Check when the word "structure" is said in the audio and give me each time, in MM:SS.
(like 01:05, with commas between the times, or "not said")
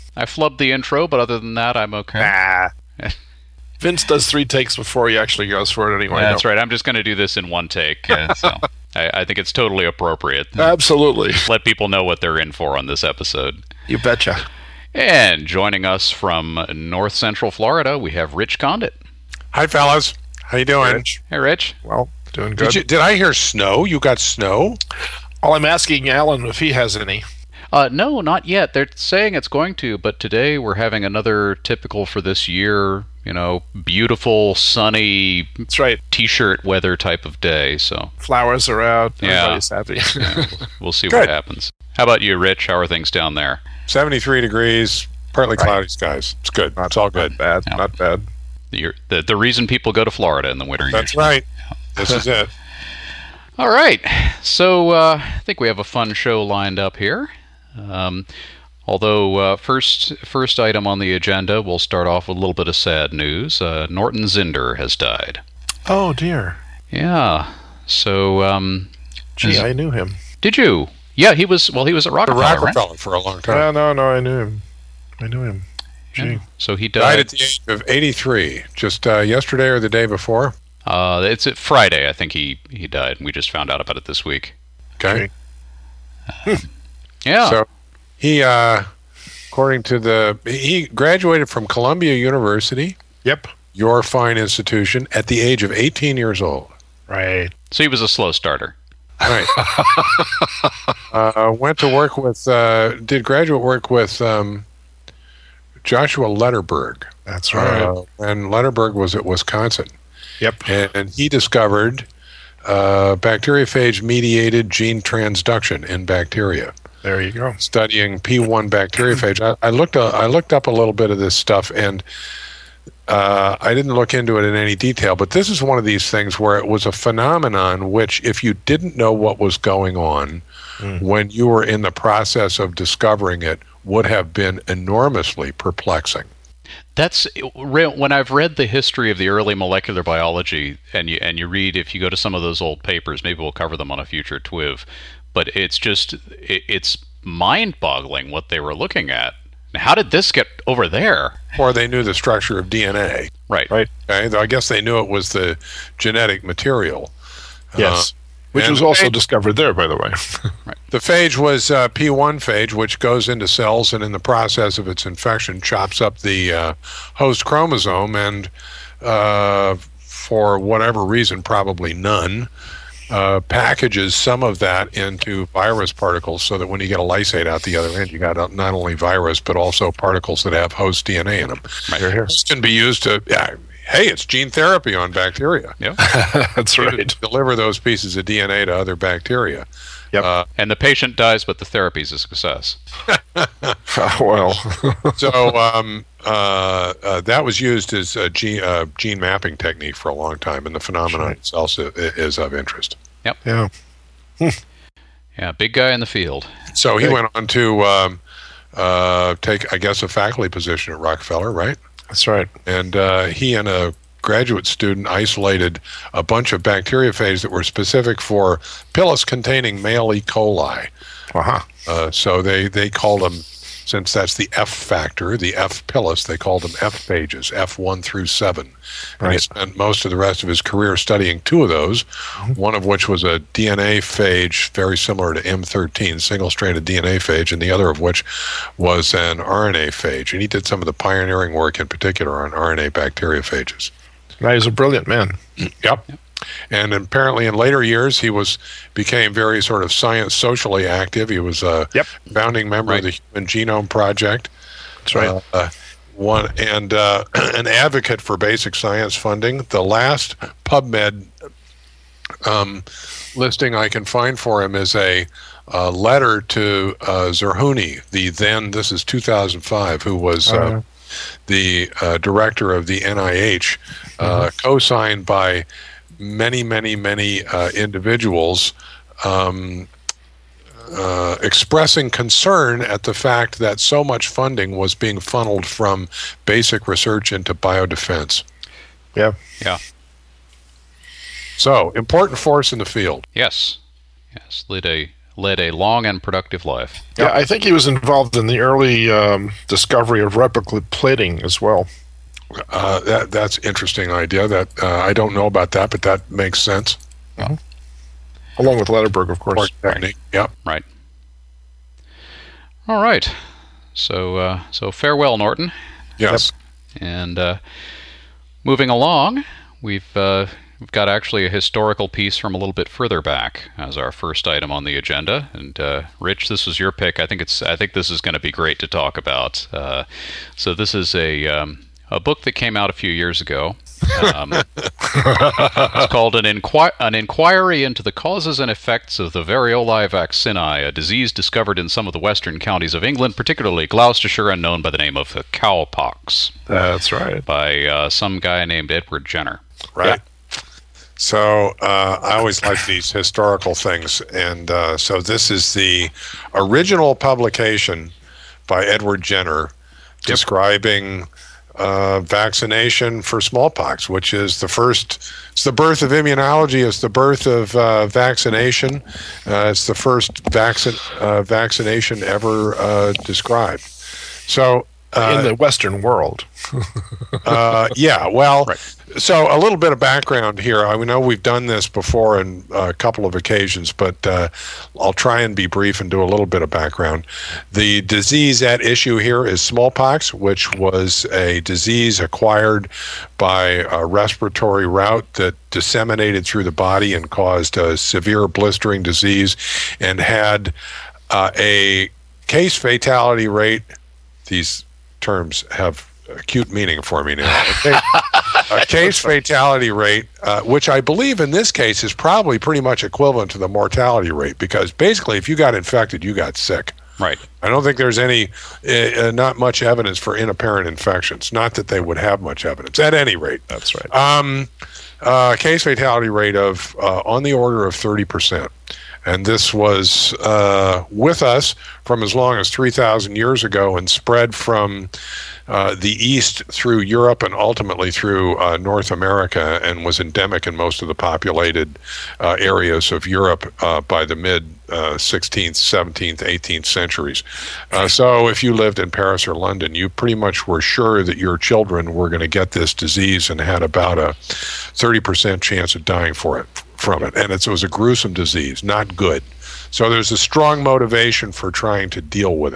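02:32.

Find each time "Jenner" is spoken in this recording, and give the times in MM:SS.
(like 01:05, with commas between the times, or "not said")
05:49, 05:59.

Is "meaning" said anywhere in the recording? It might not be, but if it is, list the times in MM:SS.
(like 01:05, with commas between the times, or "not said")
06:46.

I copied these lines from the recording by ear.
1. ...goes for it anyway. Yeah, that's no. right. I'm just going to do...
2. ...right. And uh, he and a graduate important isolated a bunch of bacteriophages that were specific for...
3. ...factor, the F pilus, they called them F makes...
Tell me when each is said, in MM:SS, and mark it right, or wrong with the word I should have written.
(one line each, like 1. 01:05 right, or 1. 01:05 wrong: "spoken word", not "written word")
1. 00:05 right
2. 03:32 wrong: "student", not "important"
3. 03:44 wrong: "phages", not "makes".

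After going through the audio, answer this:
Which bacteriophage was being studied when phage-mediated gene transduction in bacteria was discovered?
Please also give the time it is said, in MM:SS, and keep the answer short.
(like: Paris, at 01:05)
P1, at 01:58.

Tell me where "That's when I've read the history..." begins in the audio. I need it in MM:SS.
02:16.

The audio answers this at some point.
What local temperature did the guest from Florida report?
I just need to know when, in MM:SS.
00:43.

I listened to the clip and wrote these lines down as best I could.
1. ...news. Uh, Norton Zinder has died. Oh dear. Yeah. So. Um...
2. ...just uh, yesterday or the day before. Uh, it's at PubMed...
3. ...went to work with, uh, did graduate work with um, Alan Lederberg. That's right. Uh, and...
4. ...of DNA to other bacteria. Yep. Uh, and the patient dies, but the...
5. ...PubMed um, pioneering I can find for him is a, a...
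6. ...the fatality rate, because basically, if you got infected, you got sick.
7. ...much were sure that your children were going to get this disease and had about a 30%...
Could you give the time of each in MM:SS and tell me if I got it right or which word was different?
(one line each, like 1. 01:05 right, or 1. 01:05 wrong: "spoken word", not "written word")
1. 01:03 right
2. 01:18 wrong: "Friday", not "PubMed"
3. 01:41 wrong: "Joshua", not "Alan"
4. 03:08 right
5. 04:20 wrong: "listing", not "pioneering"
6. 06:53 wrong: "mortality", not "fatality"
7. 07:30 right.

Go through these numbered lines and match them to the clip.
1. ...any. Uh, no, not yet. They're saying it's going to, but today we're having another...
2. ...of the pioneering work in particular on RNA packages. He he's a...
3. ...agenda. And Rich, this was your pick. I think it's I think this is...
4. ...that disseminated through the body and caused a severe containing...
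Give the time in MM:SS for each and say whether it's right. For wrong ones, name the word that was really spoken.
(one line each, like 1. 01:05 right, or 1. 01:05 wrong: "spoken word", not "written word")
1. 00:26 right
2. 04:00 wrong: "bacteriophages", not "packages"
3. 05:24 right
4. 06:35 wrong: "blistering", not "containing".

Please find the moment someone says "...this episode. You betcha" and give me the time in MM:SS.
00:12.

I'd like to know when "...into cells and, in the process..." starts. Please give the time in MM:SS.
02:43.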